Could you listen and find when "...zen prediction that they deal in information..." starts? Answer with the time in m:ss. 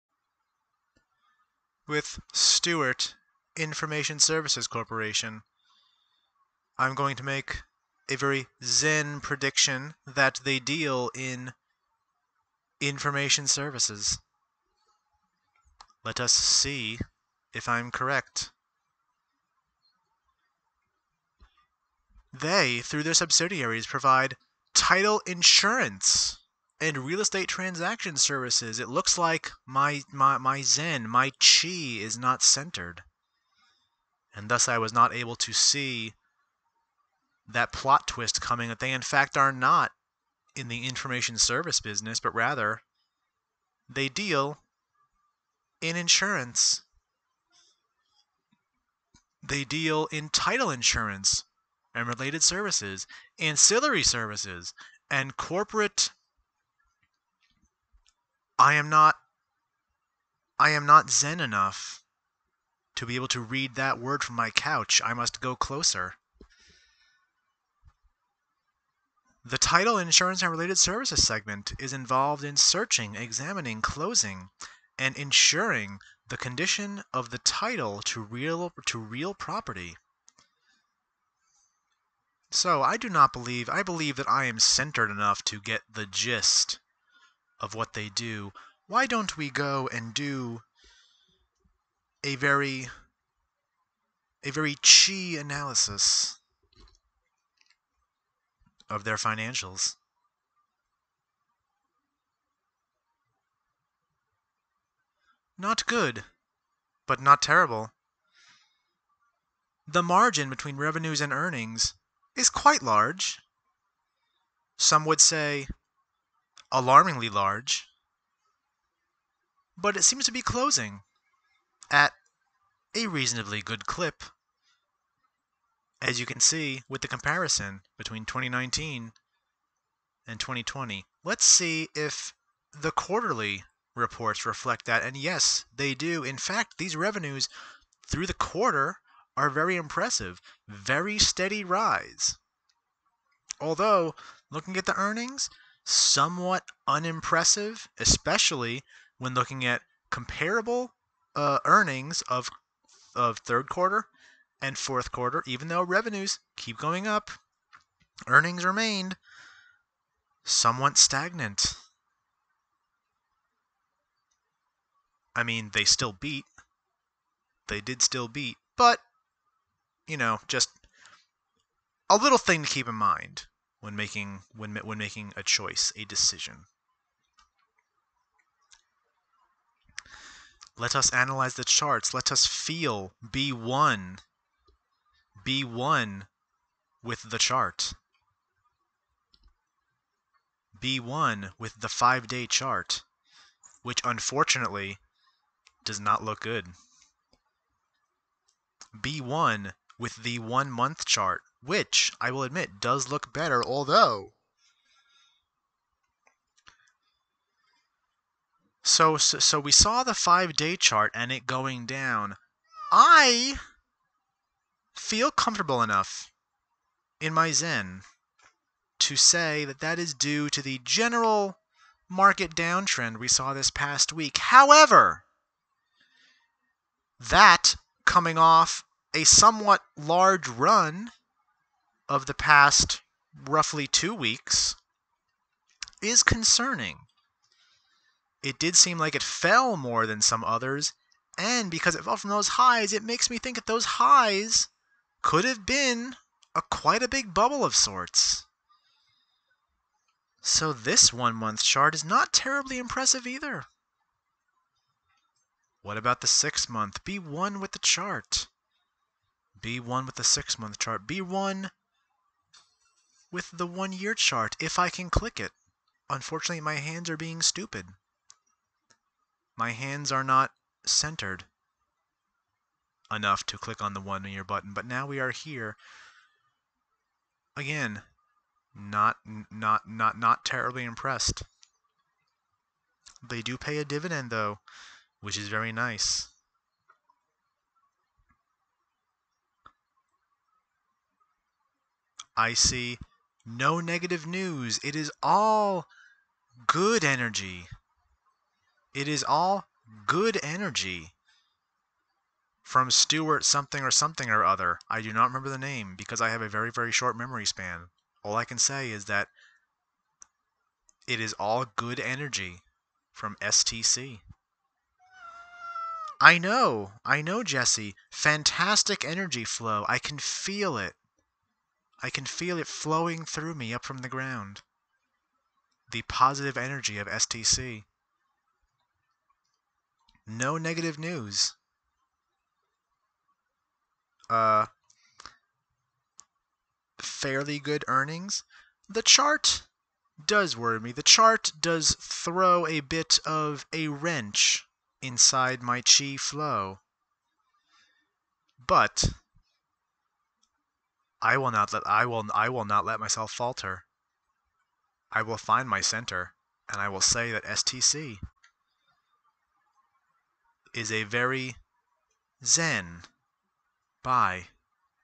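0:08.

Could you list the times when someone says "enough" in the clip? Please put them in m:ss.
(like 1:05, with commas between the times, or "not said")
1:01, 1:25, 3:35, 4:33.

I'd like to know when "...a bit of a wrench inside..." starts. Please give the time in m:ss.
5:42.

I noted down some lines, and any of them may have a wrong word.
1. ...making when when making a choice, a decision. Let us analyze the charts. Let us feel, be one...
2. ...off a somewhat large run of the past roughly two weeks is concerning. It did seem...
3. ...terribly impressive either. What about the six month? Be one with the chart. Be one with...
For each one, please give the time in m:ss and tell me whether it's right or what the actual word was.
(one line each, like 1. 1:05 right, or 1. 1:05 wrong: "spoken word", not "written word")
1. 2:53 right
2. 3:48 right
3. 4:12 right.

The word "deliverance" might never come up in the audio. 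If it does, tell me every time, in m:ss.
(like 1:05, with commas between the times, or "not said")
not said.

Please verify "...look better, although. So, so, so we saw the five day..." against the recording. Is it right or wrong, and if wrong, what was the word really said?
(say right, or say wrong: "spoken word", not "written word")
right.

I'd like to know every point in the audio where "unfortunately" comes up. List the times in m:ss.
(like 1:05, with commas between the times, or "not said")
3:14, 4:26.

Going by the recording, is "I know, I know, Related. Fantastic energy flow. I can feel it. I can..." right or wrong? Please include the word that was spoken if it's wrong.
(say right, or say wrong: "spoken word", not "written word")
wrong: "Jesse", not "Related".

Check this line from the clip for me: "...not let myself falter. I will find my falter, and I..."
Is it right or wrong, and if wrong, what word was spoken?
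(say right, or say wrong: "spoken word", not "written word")
wrong: "center", not "falter".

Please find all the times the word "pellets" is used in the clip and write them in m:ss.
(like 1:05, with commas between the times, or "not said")
not said.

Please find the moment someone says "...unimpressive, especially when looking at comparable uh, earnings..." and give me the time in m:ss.
2:26.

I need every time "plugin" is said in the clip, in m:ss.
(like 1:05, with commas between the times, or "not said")
not said.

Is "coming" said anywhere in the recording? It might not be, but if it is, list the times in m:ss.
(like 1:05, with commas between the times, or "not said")
0:38, 3:48.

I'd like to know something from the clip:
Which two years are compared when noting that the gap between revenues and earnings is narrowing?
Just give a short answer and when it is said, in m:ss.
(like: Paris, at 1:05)
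2019 and 2020, at 2:08.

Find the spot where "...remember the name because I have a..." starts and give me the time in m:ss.
5:05.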